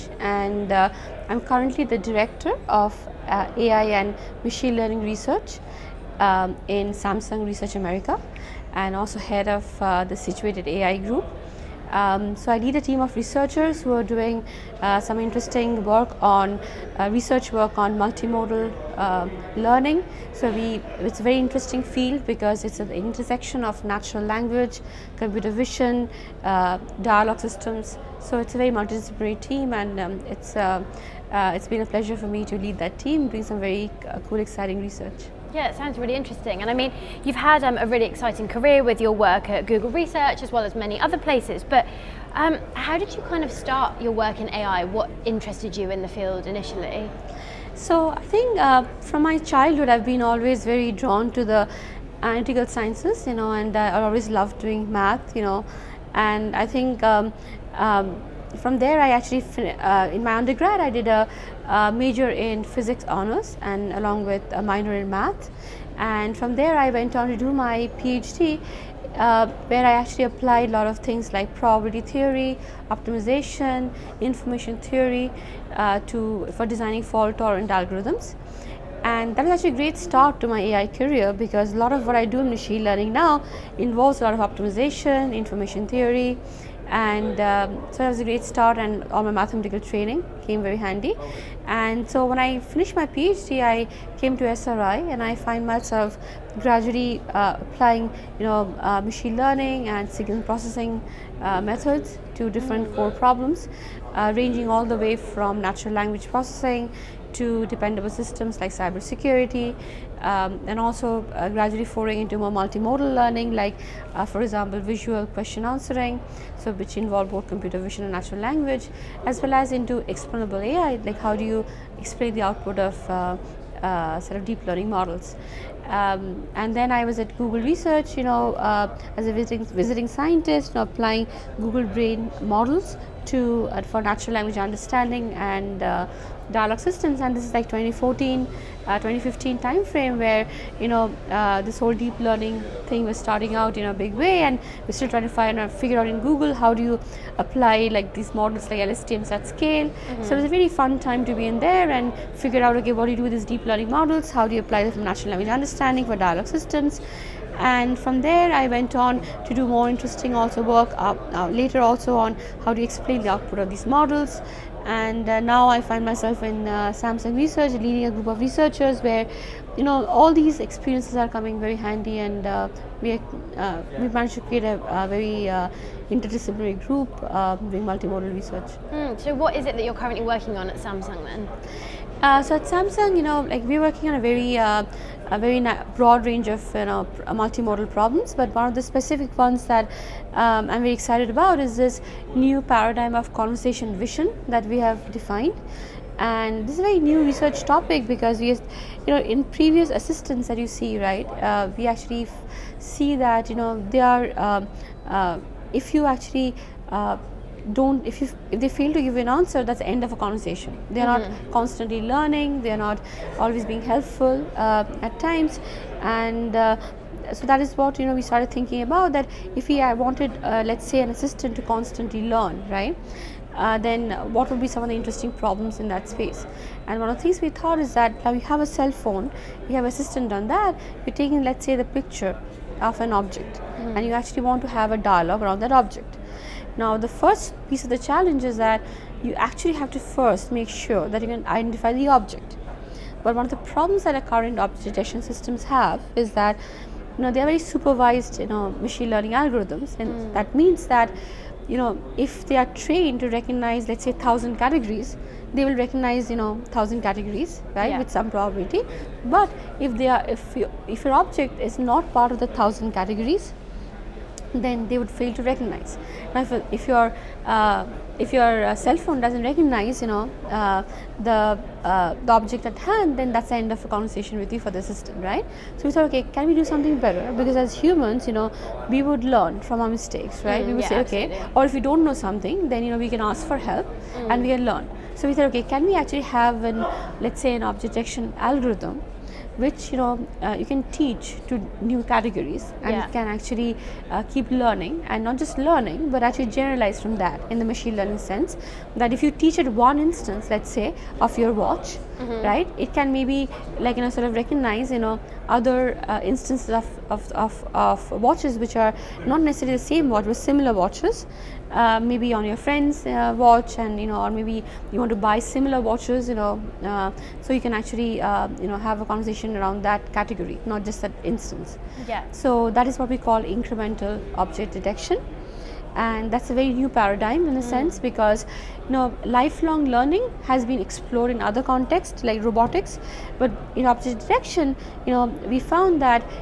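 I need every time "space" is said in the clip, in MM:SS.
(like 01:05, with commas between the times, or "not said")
03:46.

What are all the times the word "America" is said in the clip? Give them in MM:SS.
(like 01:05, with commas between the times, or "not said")
00:07.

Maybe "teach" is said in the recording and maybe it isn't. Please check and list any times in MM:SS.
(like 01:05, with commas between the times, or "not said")
04:50, 04:59.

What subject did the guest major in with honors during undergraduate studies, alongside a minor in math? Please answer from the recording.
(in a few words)
Physics.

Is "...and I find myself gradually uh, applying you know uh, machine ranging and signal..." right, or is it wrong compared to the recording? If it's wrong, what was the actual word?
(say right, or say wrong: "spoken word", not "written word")
wrong: "learning", not "ranging".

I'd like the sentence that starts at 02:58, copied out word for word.
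Mm, so what is it that you're currently working on at Samsung then?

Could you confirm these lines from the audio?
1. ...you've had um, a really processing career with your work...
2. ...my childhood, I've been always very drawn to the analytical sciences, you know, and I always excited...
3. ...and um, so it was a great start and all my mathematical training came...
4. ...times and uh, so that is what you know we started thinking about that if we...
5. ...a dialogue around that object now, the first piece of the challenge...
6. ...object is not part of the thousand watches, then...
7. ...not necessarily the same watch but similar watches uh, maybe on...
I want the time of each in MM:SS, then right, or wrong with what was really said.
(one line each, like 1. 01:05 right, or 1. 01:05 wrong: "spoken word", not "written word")
1. 00:37 wrong: "exciting", not "processing"
2. 00:49 wrong: "loved", not "excited"
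3. 01:26 right
4. 03:35 right
5. 03:54 right
6. 04:21 wrong: "categories", not "watches"
7. 05:09 right.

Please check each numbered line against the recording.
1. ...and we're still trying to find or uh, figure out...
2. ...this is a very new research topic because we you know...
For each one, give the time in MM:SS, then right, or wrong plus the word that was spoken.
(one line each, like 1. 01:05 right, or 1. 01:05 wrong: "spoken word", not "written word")
1. 02:24 right
2. 03:16 right.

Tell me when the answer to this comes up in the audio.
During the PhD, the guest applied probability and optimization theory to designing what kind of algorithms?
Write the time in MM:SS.
01:17.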